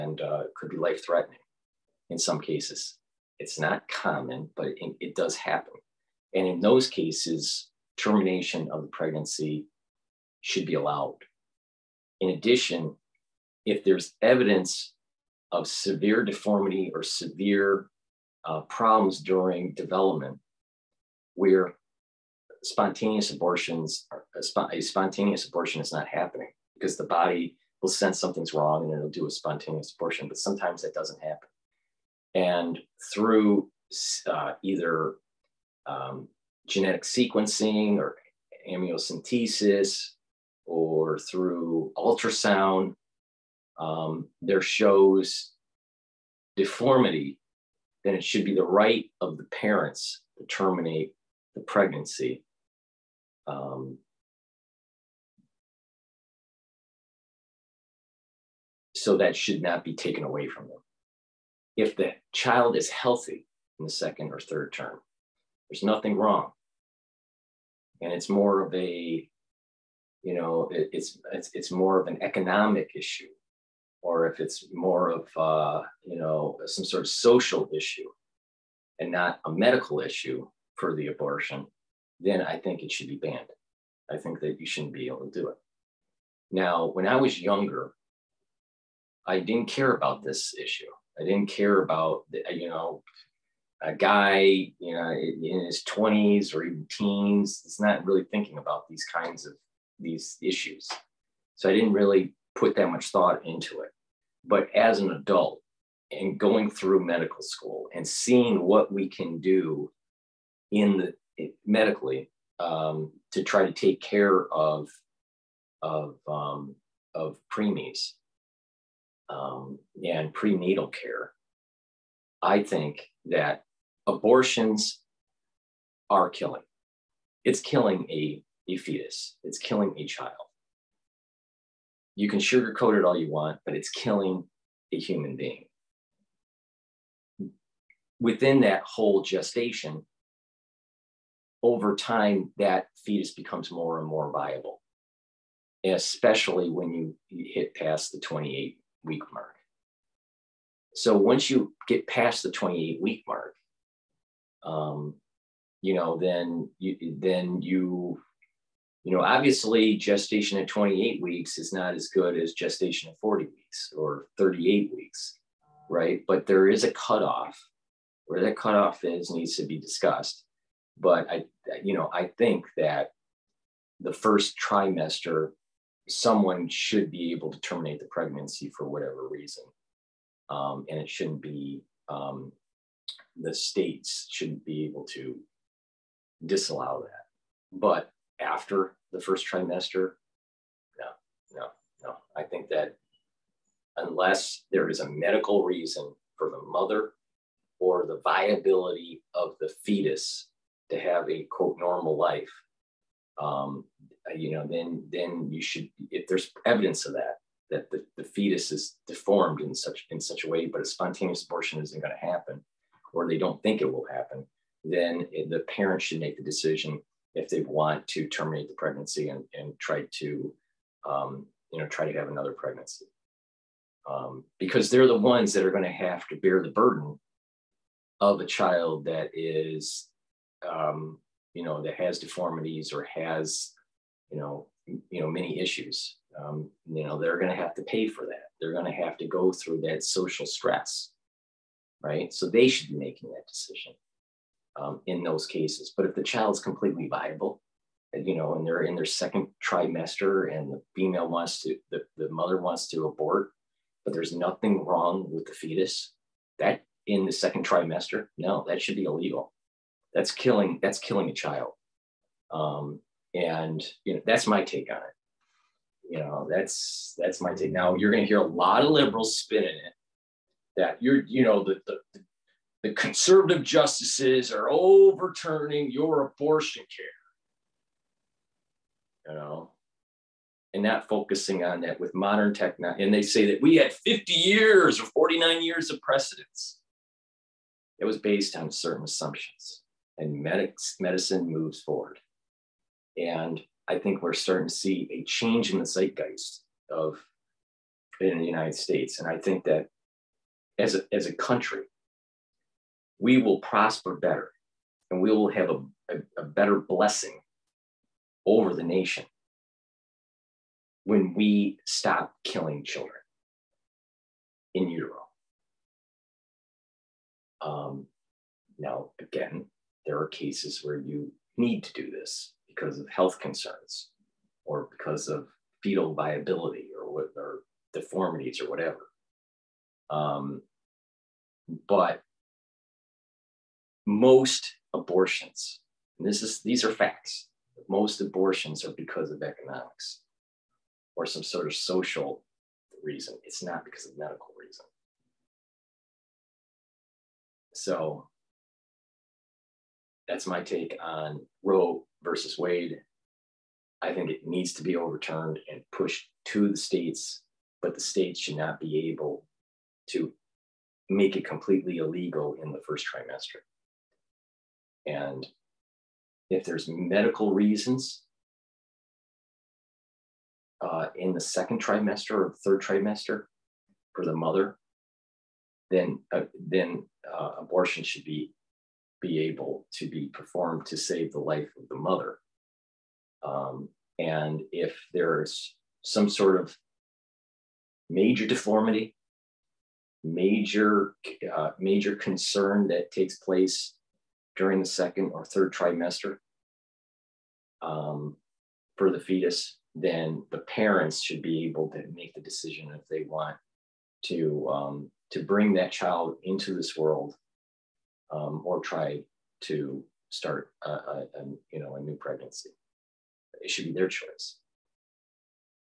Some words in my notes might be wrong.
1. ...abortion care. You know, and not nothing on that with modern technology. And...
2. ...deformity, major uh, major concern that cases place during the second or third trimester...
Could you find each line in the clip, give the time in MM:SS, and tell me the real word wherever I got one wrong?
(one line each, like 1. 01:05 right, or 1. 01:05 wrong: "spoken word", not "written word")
1. 04:36 wrong: "focusing", not "nothing"
2. 06:28 wrong: "takes", not "cases".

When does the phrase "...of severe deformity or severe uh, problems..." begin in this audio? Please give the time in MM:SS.
00:15.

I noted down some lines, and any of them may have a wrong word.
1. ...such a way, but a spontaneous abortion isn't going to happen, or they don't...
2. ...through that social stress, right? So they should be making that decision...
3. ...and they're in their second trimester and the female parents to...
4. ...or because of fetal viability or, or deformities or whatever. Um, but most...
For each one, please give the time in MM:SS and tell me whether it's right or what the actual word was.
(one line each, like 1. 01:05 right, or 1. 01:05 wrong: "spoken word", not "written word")
1. 03:30 right
2. 03:59 right
3. 04:08 wrong: "wants", not "parents"
4. 05:24 right.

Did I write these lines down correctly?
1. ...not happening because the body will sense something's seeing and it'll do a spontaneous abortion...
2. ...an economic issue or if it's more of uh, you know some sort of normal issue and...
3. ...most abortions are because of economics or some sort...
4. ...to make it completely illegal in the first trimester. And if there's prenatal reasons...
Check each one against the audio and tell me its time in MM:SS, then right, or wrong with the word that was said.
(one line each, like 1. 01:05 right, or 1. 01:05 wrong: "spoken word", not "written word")
1. 00:25 wrong: "wrong", not "seeing"
2. 01:12 wrong: "social", not "normal"
3. 05:37 right
4. 06:00 wrong: "medical", not "prenatal".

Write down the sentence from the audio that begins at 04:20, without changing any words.
That's killing, that's killing a child.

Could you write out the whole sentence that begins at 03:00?
Um, and it shouldn't be, um, the states shouldn't be able to disallow that.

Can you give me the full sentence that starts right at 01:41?
So I didn't really put that much thought into it.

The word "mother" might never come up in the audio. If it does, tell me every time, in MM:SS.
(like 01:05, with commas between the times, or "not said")
03:16, 04:12, 06:14, 06:21.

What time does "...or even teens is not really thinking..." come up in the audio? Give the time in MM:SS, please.
01:36.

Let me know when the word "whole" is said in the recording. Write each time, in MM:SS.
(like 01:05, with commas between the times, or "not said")
02:18.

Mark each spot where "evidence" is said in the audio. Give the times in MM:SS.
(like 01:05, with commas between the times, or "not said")
00:14, 03:26.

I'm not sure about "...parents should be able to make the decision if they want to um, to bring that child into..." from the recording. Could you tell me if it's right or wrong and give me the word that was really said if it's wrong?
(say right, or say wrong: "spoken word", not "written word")
right.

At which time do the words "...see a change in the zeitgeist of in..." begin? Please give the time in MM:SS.
04:54.